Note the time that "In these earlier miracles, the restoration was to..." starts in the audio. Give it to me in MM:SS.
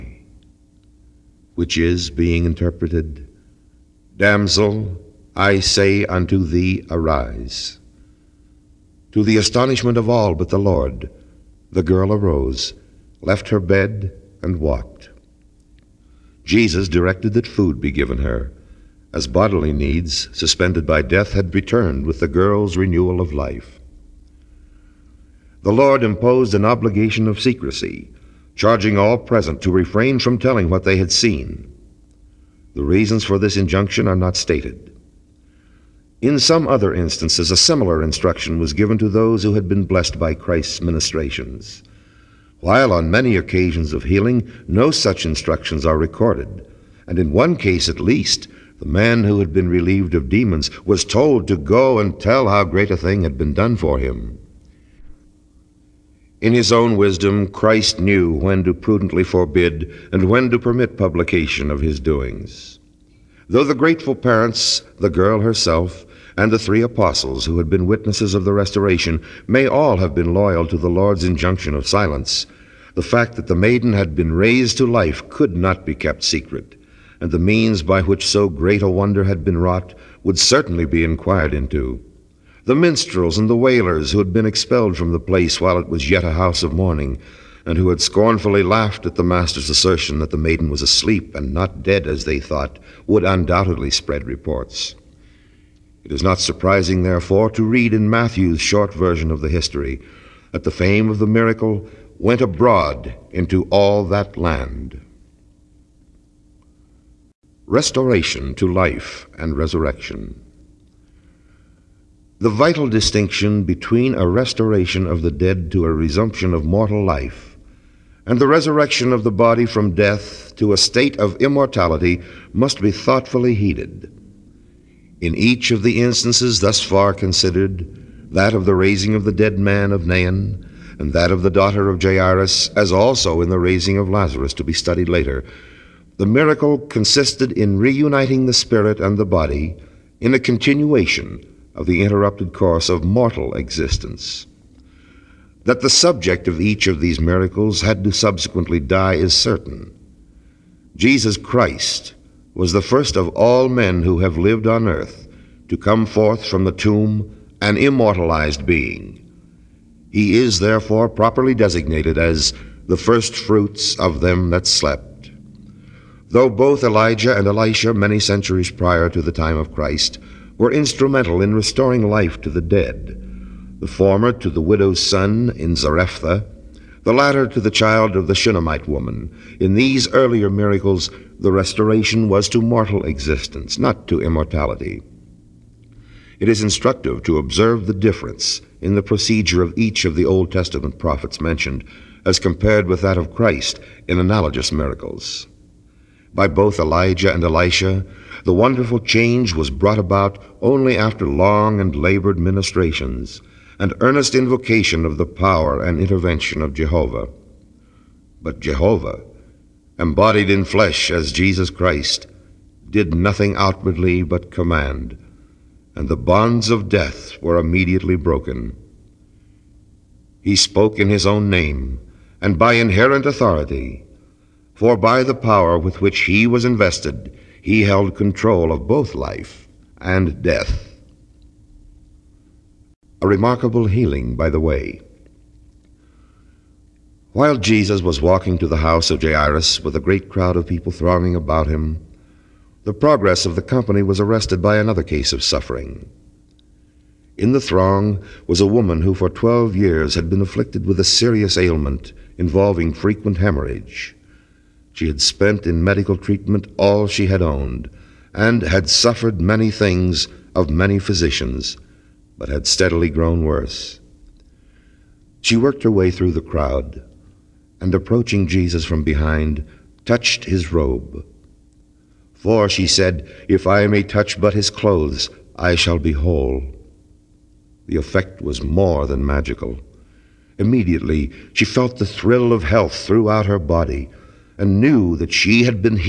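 02:59.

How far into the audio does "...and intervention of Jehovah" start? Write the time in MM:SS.
03:25.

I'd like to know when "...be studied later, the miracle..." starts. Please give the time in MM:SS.
02:14.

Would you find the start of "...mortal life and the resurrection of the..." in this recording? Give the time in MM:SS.
01:56.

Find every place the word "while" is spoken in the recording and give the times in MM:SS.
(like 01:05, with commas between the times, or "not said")
00:42, 01:25, 03:57.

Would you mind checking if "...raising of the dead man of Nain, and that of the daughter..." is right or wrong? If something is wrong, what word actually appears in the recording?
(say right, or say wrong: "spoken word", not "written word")
right.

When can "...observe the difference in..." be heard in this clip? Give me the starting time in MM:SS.
03:07.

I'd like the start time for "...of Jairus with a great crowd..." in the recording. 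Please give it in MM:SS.
03:59.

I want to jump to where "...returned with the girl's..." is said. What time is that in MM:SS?
00:21.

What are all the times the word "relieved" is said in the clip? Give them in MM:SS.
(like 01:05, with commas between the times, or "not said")
00:49.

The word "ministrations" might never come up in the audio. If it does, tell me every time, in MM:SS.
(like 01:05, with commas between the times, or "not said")
00:40, 03:22.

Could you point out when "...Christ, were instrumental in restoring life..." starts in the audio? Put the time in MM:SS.
02:49.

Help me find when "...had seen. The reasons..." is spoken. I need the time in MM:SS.
00:30.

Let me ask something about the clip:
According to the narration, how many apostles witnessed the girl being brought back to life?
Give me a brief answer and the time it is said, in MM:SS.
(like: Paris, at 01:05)
3, at 01:06.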